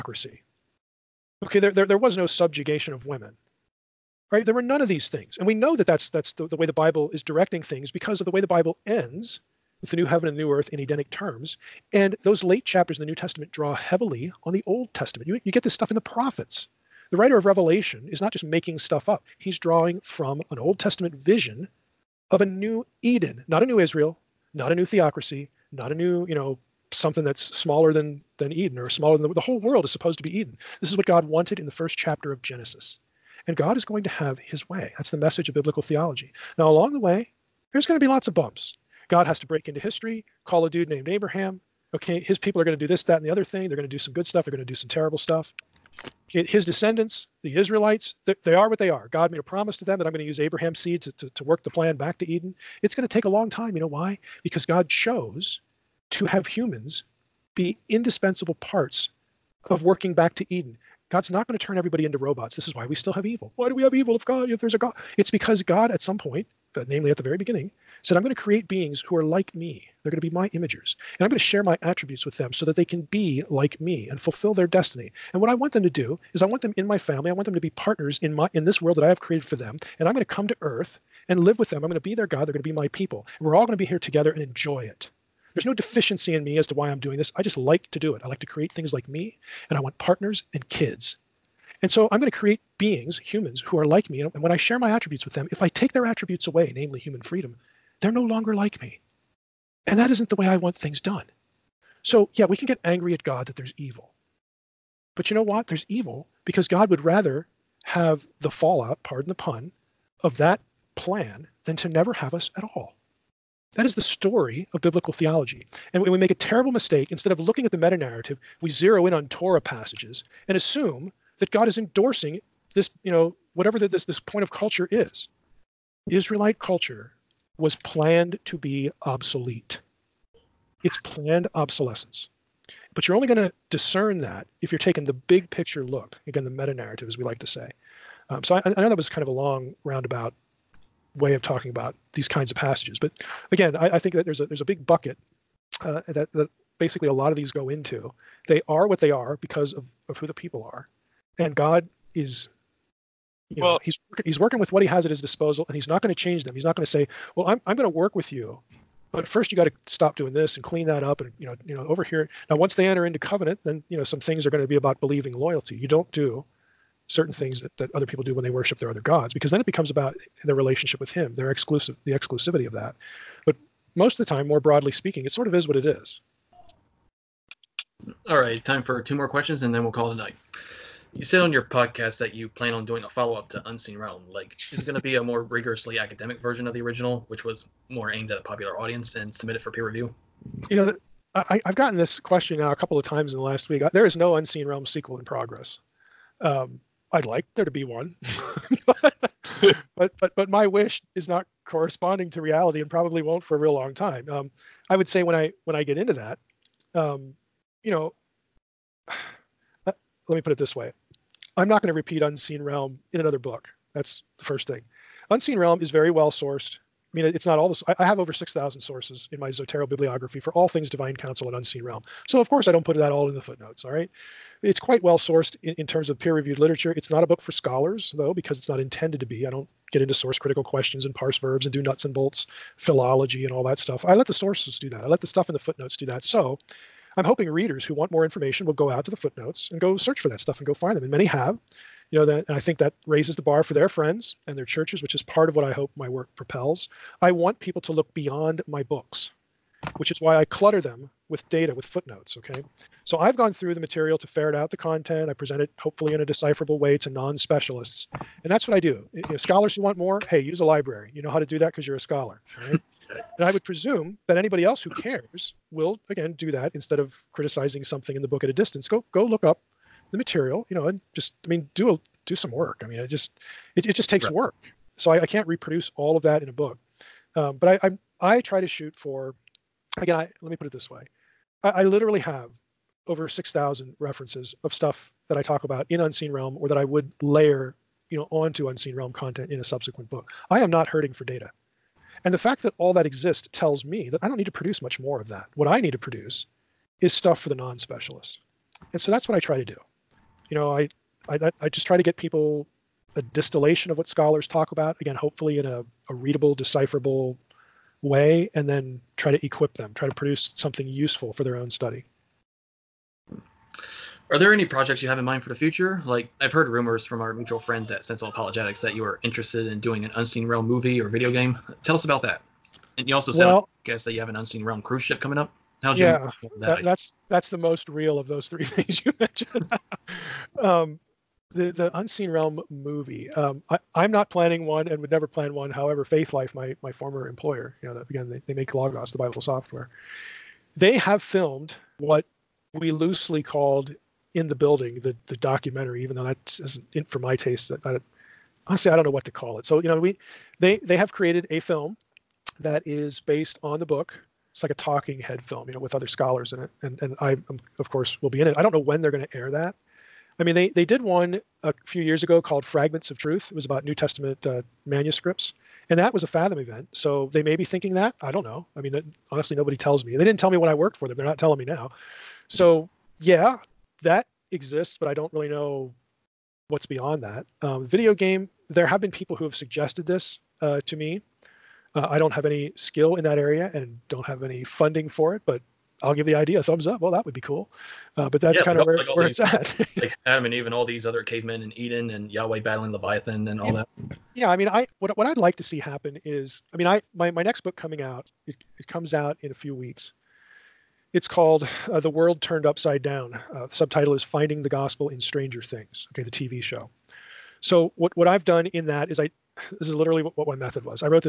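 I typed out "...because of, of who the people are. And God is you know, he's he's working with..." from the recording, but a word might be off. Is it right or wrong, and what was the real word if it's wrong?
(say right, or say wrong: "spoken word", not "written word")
right.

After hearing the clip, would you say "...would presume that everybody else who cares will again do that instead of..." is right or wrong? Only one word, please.
wrong.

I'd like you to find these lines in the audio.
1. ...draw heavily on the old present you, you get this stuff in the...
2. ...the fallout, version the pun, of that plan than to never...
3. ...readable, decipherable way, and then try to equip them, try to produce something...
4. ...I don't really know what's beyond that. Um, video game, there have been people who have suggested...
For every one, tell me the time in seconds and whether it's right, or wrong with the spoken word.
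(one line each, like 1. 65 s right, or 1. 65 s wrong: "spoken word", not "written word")
1. 13 s wrong: "testament", not "present"
2. 108 s wrong: "pardon", not "version"
3. 306 s right
4. 375 s right.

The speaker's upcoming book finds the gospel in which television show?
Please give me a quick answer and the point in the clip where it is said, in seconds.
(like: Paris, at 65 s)
Stranger Things, at 405 s.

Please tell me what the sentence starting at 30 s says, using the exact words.
This is what God wanted in the first chapter of Genesis.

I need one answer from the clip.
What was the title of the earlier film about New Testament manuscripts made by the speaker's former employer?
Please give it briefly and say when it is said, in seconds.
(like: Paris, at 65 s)
Fragments of Truth, at 362 s.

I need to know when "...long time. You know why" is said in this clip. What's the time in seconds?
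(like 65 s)
53 s.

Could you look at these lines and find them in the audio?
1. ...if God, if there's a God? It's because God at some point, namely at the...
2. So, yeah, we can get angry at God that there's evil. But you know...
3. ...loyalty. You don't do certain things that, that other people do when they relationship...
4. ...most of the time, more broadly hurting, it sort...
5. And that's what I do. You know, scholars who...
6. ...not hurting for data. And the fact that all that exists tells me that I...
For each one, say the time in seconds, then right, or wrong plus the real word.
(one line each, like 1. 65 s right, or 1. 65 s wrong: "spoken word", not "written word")
1. 64 s right
2. 102 s right
3. 165 s wrong: "worship", not "relationship"
4. 173 s wrong: "speaking", not "hurting"
5. 258 s right
6. 290 s right.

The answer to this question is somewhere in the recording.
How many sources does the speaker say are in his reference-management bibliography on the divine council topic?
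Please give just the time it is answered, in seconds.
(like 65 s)
218 s.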